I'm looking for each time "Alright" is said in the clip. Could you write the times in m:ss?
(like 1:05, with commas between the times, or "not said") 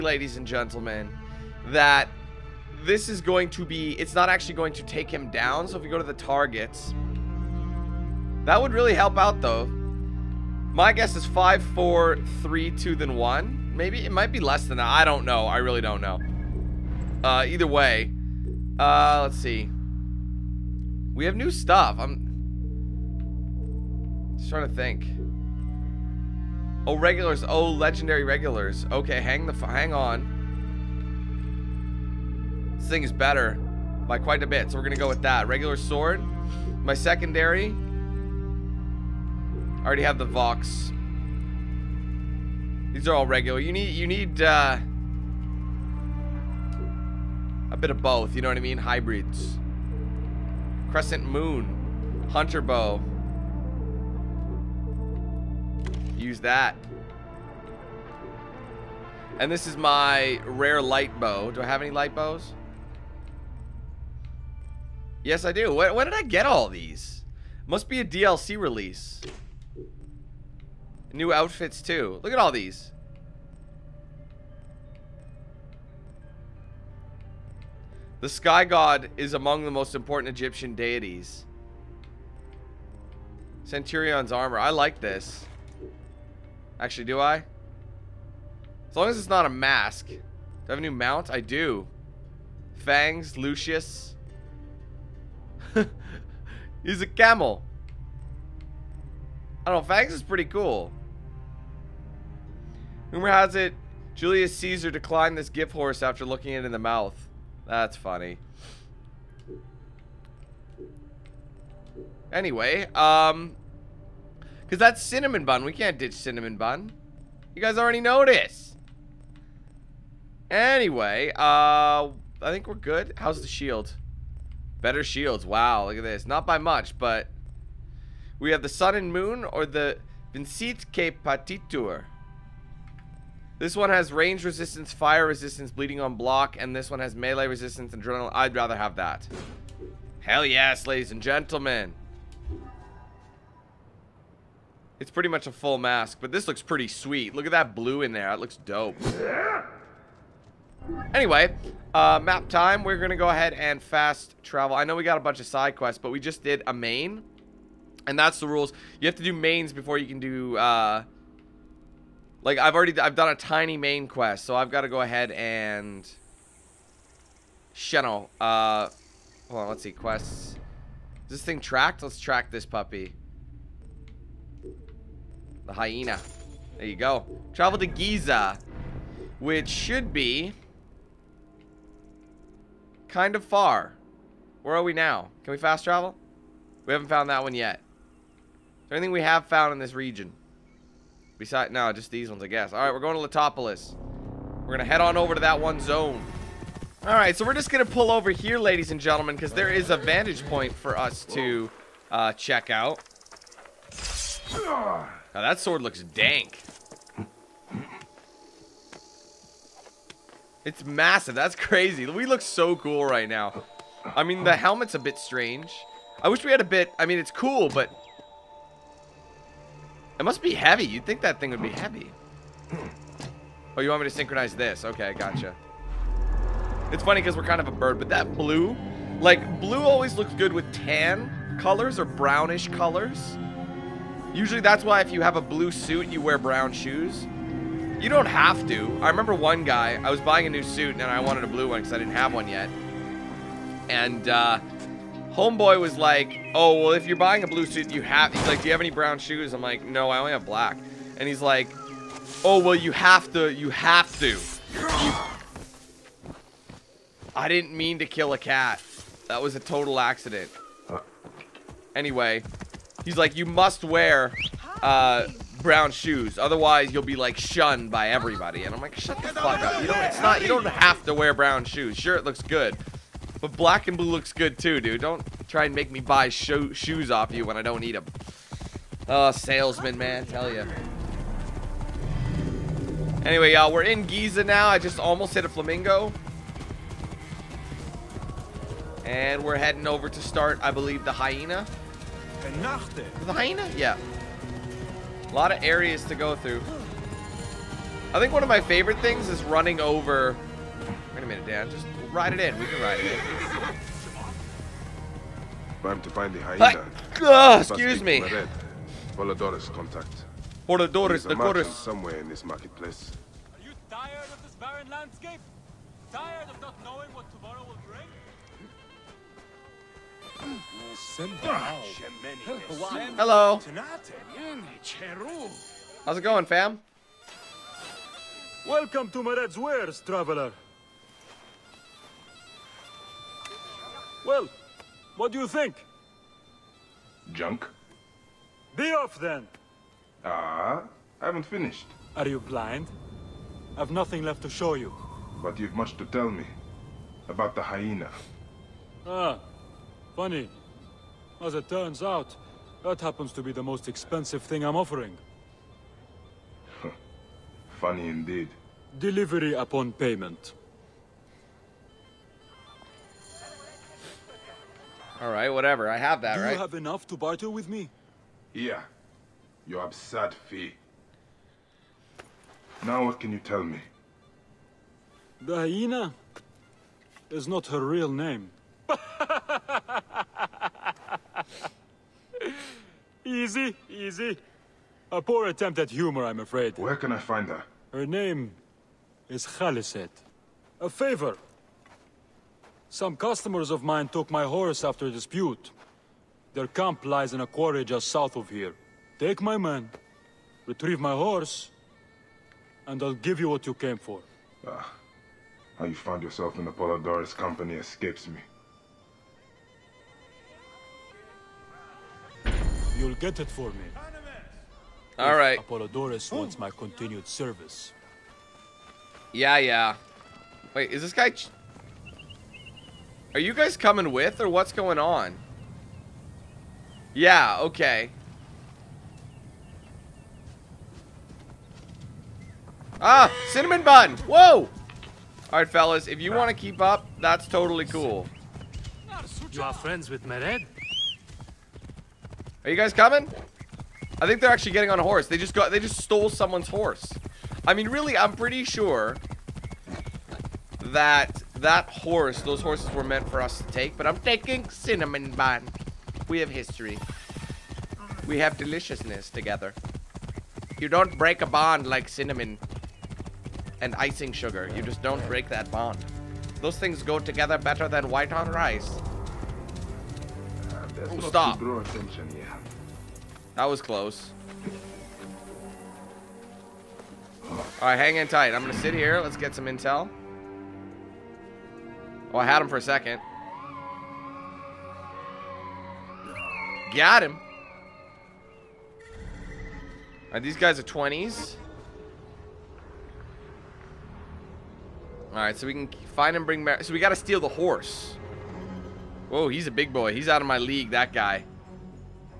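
7:15.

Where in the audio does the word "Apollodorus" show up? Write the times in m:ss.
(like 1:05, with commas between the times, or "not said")
6:46, 6:55.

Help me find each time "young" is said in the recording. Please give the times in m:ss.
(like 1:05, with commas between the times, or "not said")
not said.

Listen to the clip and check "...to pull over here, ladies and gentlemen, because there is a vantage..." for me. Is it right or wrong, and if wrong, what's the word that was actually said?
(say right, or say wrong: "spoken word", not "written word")
right.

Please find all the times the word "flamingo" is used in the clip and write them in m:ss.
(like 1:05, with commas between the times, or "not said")
4:45.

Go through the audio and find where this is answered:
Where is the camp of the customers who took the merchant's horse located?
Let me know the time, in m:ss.
6:37.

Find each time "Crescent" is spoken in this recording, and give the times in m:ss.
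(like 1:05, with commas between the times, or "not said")
0:50.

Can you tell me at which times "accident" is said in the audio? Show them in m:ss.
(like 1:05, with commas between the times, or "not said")
4:19.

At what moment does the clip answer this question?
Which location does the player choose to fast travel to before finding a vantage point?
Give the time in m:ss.
3:13.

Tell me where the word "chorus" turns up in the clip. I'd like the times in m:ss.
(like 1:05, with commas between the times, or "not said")
5:11.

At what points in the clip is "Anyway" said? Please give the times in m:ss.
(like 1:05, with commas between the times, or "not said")
1:52, 2:00, 2:31, 4:21, 4:43.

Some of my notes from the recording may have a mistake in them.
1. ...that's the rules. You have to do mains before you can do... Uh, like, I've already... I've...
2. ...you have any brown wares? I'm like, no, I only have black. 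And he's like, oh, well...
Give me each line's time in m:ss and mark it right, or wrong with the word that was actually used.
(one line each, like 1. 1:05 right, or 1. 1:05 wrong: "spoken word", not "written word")
1. 2:38 right
2. 4:08 wrong: "shoes", not "wares".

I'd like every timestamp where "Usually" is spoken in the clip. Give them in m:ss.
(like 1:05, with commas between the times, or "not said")
3:54.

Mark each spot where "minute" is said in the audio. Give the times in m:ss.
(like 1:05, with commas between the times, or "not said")
5:01.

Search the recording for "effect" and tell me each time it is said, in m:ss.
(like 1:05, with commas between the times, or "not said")
not said.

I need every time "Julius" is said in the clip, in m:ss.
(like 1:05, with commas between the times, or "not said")
1:44.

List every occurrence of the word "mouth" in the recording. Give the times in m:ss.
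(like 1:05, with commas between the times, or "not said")
1:46.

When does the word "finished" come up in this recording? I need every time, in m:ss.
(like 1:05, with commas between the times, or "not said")
5:41.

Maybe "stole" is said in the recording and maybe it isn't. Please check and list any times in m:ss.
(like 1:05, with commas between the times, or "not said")
7:25.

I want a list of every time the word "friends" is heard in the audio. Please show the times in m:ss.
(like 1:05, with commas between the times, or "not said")
7:19.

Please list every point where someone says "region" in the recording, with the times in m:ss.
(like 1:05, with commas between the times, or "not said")
3:09.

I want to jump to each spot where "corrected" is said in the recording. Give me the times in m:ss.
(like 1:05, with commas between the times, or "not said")
not said.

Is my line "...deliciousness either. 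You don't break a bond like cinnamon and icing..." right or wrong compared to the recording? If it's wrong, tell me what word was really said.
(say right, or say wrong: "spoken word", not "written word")
wrong: "together", not "either".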